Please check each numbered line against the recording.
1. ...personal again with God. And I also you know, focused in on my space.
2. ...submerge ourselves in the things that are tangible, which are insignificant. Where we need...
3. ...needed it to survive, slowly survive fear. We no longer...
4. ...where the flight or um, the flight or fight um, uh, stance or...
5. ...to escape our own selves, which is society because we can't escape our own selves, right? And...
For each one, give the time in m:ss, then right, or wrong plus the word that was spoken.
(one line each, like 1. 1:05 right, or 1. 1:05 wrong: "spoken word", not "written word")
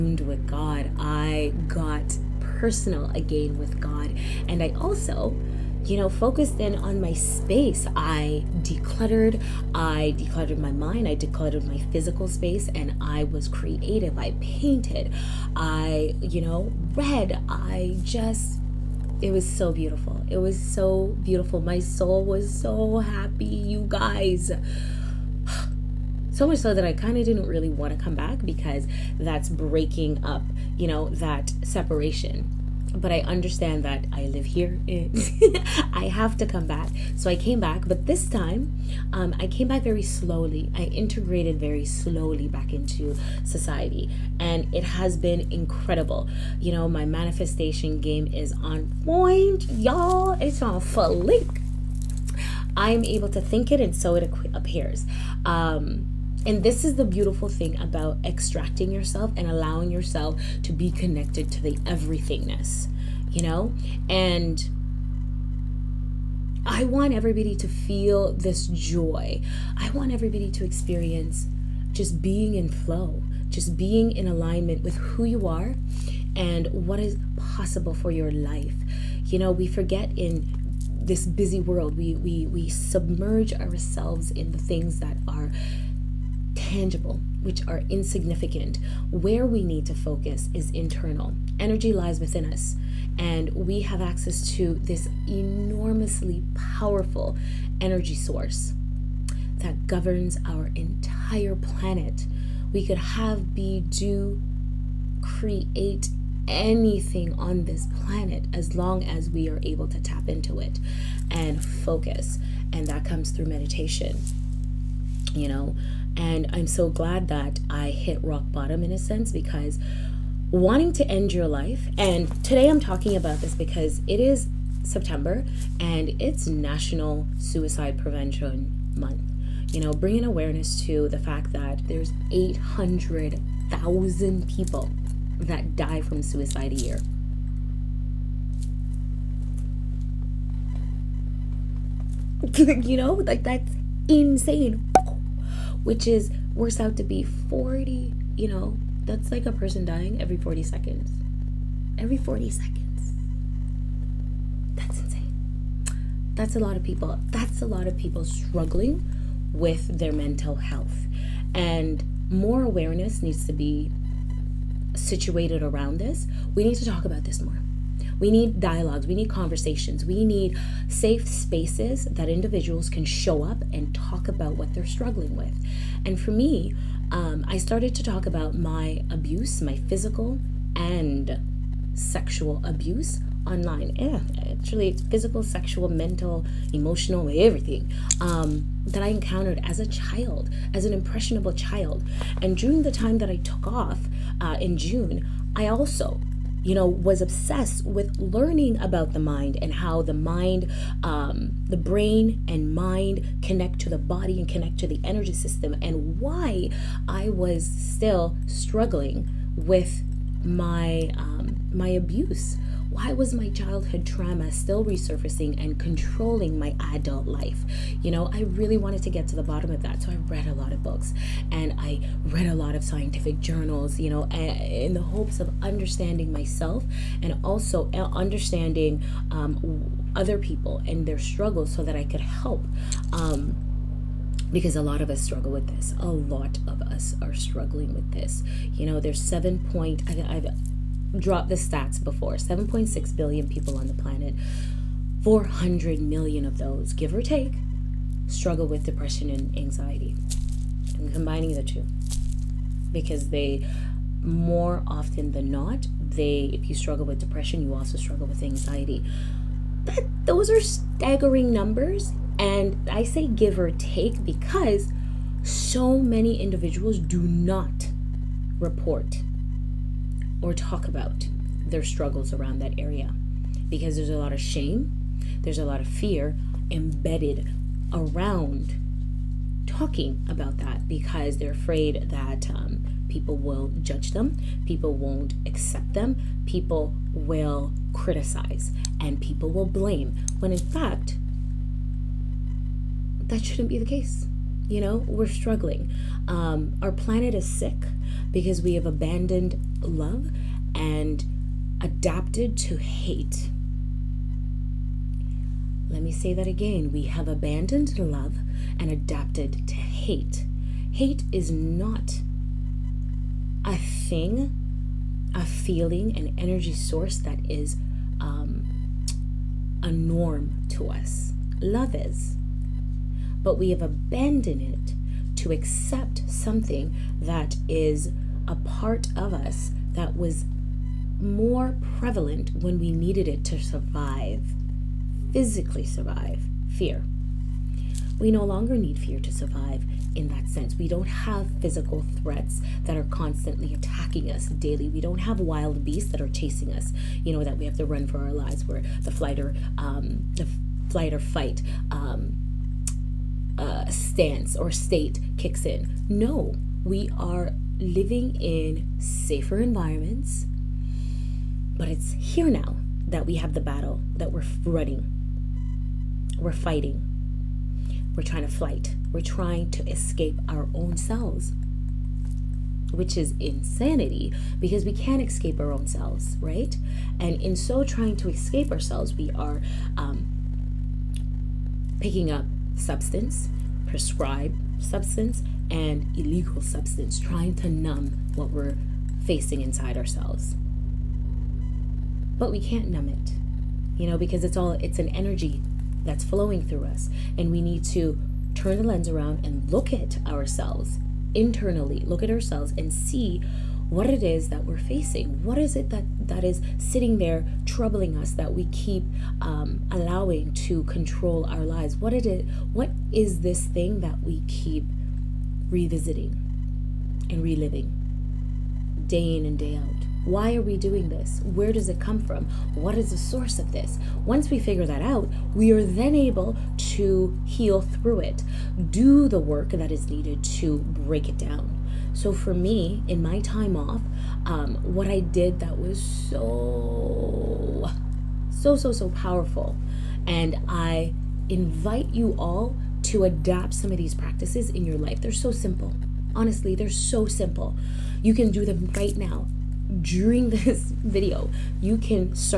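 1. 0:02 right
2. 1:22 right
3. 5:32 wrong: "physically", not "slowly"
4. 5:48 right
5. 6:09 wrong: "insanity", not "society".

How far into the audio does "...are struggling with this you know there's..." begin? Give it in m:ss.
3:57.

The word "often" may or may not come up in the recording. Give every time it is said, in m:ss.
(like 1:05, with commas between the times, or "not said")
4:14.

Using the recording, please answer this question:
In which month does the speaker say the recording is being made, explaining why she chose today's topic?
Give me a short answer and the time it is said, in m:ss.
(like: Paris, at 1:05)
September, at 2:04.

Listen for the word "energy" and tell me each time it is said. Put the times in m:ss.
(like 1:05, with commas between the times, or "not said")
1:31, 1:37, 3:25, 5:16, 6:35.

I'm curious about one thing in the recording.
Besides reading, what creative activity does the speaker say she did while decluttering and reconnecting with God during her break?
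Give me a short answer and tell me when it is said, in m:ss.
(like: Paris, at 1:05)
painted, at 0:14.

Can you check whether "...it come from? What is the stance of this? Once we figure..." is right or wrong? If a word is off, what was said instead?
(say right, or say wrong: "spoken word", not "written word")
wrong: "source", not "stance".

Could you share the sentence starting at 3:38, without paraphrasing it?
You know, I really wanted to get to the bottom of that.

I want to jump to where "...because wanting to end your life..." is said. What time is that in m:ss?
1:59.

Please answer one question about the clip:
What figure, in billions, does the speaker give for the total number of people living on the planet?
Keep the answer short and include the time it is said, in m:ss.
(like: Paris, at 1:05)
7.6, at 4:02.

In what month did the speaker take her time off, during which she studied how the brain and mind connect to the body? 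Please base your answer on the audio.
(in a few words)
June.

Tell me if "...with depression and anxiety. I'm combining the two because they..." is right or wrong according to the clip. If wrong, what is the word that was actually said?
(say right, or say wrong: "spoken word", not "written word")
right.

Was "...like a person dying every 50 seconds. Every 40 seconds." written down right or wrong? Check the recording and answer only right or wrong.
wrong.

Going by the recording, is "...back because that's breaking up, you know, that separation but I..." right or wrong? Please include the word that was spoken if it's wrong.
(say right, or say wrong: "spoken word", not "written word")
right.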